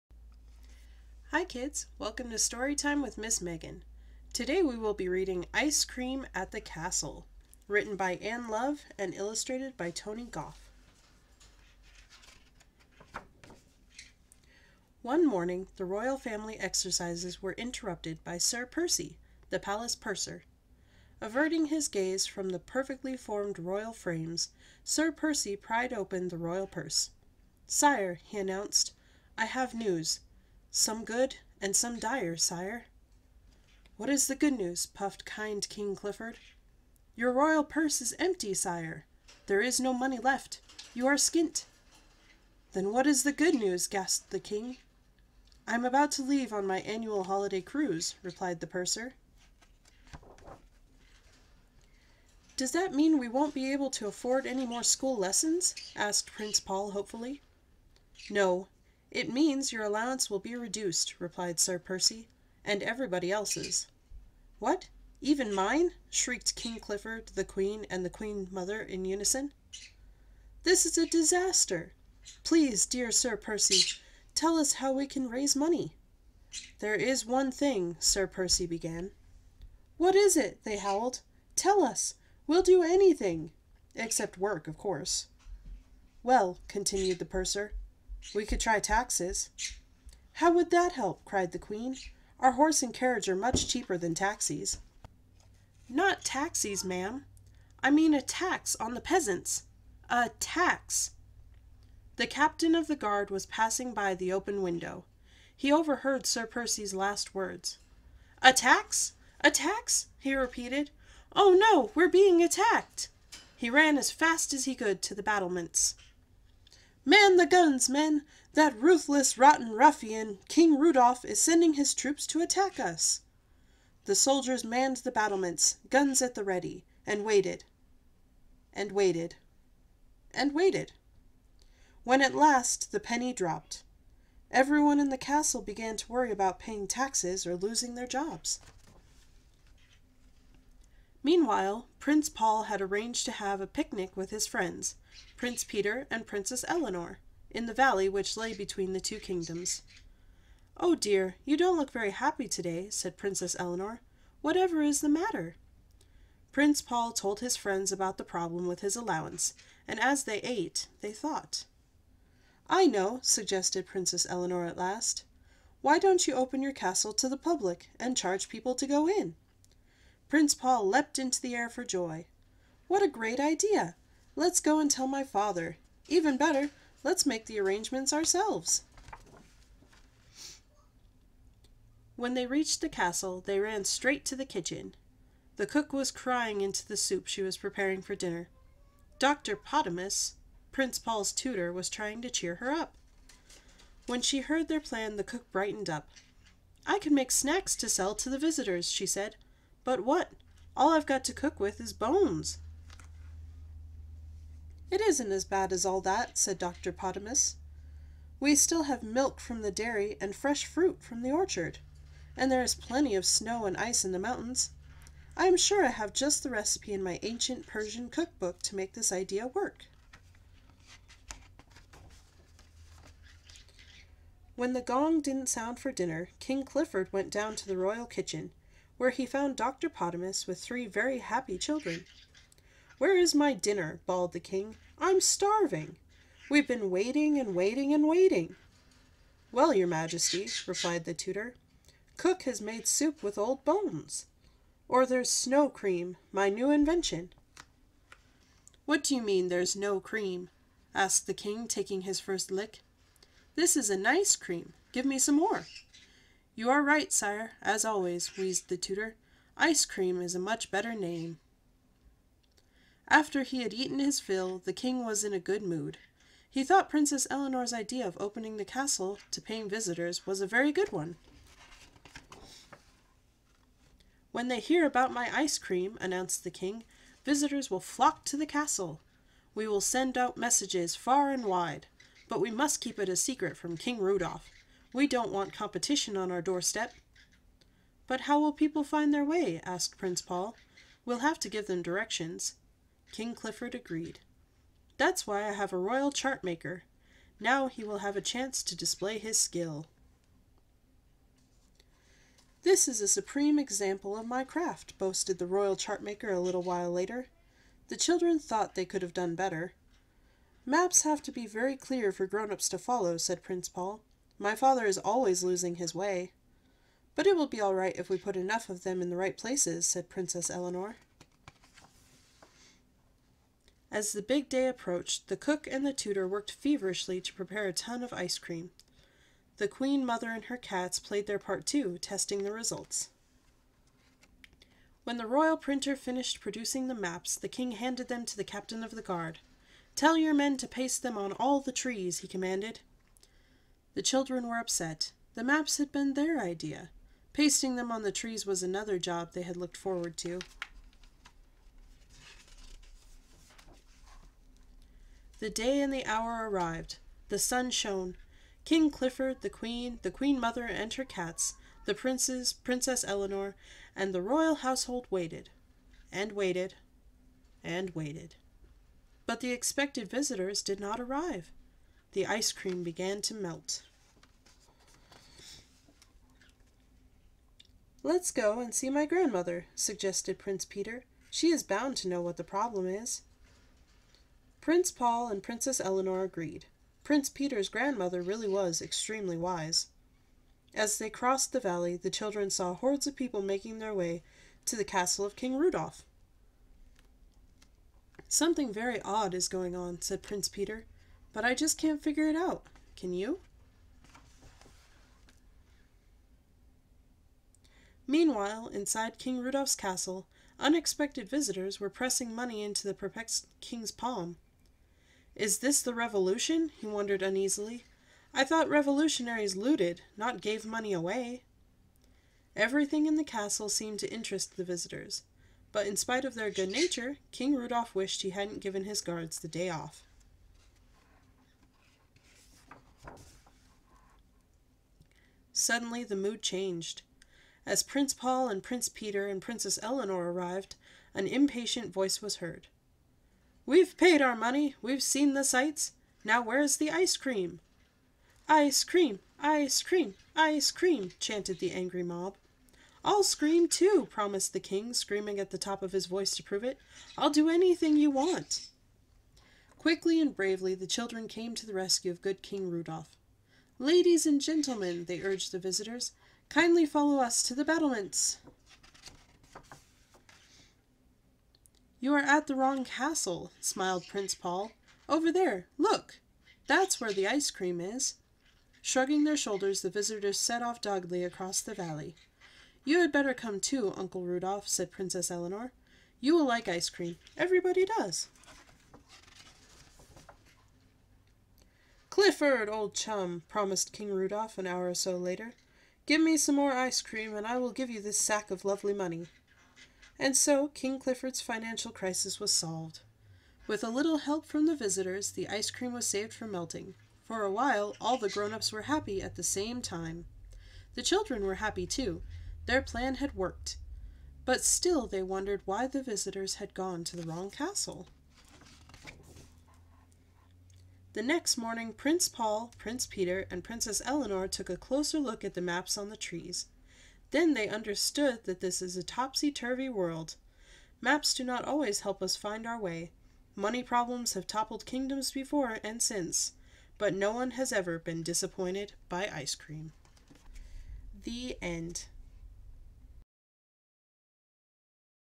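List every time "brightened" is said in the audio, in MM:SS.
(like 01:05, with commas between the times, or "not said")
03:15.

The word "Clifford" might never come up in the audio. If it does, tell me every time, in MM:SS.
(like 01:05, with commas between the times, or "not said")
00:35, 01:06, 03:46, 04:53, 05:58, 08:12, 08:20.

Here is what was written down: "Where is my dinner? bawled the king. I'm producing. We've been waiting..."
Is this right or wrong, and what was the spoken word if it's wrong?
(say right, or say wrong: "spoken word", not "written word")
wrong: "starving", not "producing".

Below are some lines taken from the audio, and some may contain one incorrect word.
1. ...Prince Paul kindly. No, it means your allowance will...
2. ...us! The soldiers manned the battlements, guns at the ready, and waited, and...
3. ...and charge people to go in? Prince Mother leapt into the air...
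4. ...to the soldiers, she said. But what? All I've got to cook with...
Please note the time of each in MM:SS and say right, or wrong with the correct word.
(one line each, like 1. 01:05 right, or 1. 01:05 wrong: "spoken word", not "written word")
1. 00:56 wrong: "hopefully", not "kindly"
2. 02:02 right
3. 02:47 wrong: "Paul", not "Mother"
4. 03:18 wrong: "visitors", not "soldiers".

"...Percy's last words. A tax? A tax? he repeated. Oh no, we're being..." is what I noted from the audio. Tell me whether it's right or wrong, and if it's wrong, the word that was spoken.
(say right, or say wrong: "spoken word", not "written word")
right.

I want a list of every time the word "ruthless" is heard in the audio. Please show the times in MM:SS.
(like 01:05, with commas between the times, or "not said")
01:58.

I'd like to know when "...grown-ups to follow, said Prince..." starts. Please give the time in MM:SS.
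05:12.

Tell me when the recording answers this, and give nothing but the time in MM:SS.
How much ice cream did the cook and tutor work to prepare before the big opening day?
05:27.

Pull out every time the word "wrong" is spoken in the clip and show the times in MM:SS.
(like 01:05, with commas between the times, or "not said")
07:52, 08:37.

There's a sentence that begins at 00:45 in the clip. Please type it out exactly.
I'm about to leave on my annual holiday cruise, replied the purser.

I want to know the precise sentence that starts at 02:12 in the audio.
When at last the penny dropped, everyone in the castle began to worry about paying taxes or losing their jobs.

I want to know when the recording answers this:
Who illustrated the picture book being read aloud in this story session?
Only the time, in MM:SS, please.
00:09.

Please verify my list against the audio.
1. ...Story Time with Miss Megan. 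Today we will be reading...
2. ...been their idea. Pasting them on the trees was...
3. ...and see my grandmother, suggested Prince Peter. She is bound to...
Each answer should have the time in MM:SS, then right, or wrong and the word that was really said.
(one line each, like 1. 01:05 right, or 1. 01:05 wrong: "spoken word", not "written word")
1. 00:02 right
2. 05:45 right
3. 06:18 right.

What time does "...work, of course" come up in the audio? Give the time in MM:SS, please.
01:24.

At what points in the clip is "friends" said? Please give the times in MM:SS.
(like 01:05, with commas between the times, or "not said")
02:24, 02:37.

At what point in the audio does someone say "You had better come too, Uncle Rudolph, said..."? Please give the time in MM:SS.
08:02.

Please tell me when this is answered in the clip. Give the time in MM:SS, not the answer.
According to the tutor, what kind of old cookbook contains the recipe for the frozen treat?
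03:37.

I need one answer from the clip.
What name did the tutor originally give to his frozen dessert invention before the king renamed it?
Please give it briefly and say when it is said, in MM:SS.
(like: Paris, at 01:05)
Snow cream, at 04:05.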